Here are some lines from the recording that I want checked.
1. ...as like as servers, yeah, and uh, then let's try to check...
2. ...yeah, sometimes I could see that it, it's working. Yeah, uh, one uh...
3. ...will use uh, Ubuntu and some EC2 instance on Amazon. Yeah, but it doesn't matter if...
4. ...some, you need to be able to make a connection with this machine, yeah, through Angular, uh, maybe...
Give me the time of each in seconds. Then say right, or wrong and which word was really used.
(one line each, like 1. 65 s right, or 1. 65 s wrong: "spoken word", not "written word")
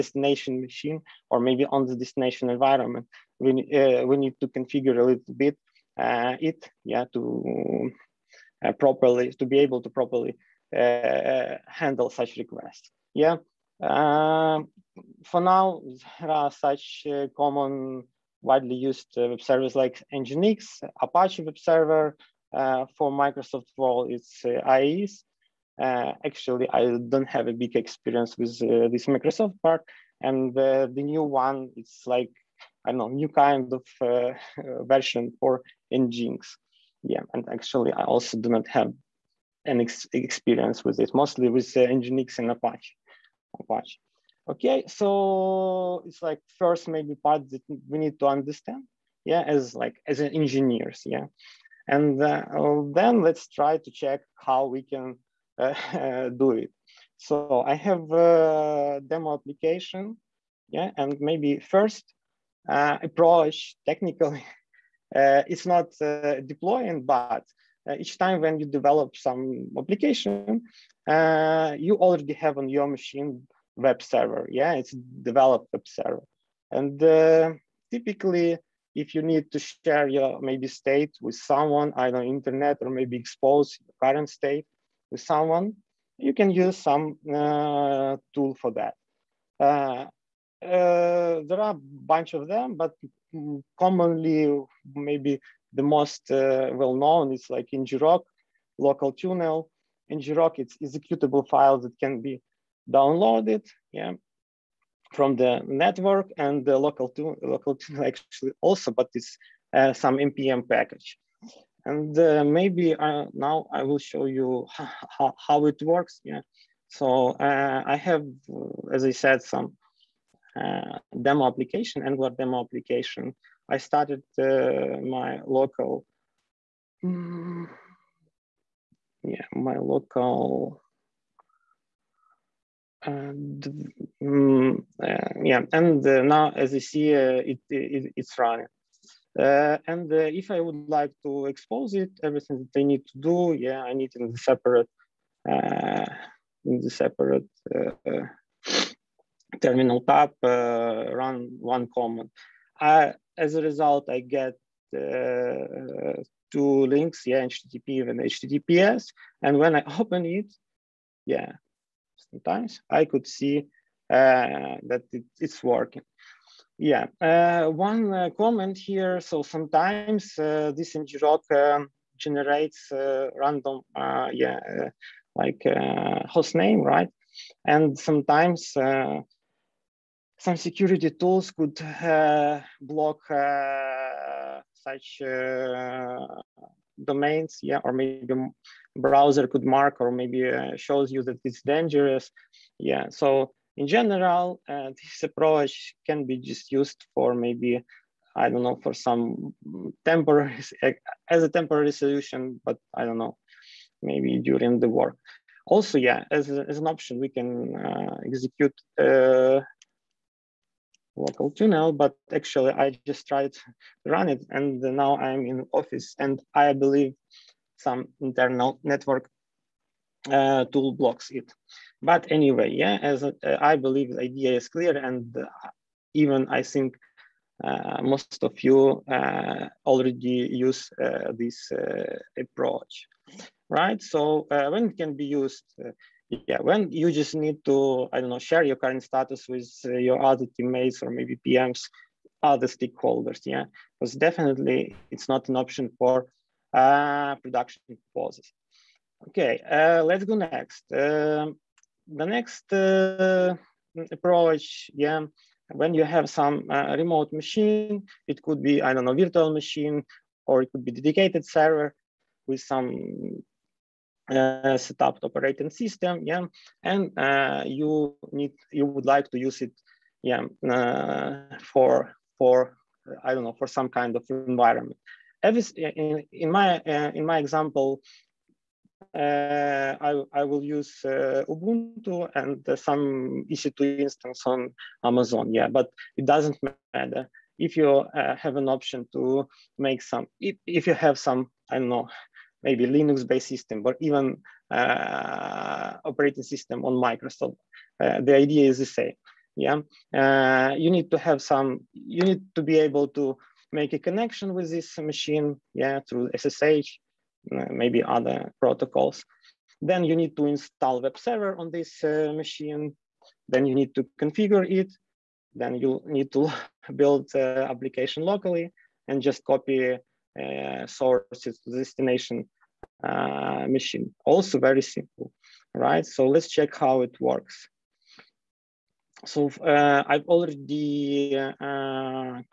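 1. 49 s wrong: "engineers", not "servers"
2. 161 s right
3. 280 s right
4. 301 s wrong: "SSH", not "Angular".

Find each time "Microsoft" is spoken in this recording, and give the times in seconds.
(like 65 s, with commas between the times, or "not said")
23 s, 29 s, 296 s.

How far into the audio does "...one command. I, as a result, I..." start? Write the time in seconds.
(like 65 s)
151 s.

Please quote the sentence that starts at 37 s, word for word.
Yeah, and actually, I also do not have an ex experience with it, mostly with uh, Nginx and Apache.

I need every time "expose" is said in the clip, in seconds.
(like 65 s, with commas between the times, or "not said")
83 s, 141 s.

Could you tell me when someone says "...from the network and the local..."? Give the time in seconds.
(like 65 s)
105 s.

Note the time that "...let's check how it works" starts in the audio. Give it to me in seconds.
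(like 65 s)
326 s.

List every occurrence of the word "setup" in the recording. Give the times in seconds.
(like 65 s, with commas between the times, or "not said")
264 s.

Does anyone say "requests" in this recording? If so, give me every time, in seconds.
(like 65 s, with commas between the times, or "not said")
12 s.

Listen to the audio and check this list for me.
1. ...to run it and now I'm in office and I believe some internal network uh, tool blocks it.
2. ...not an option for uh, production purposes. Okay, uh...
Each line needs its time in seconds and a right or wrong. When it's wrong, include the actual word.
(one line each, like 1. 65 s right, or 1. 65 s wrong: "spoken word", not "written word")
1. 213 s right
2. 245 s right.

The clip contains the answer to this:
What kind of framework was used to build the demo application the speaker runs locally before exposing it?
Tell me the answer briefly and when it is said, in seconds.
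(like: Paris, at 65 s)
Angular, at 122 s.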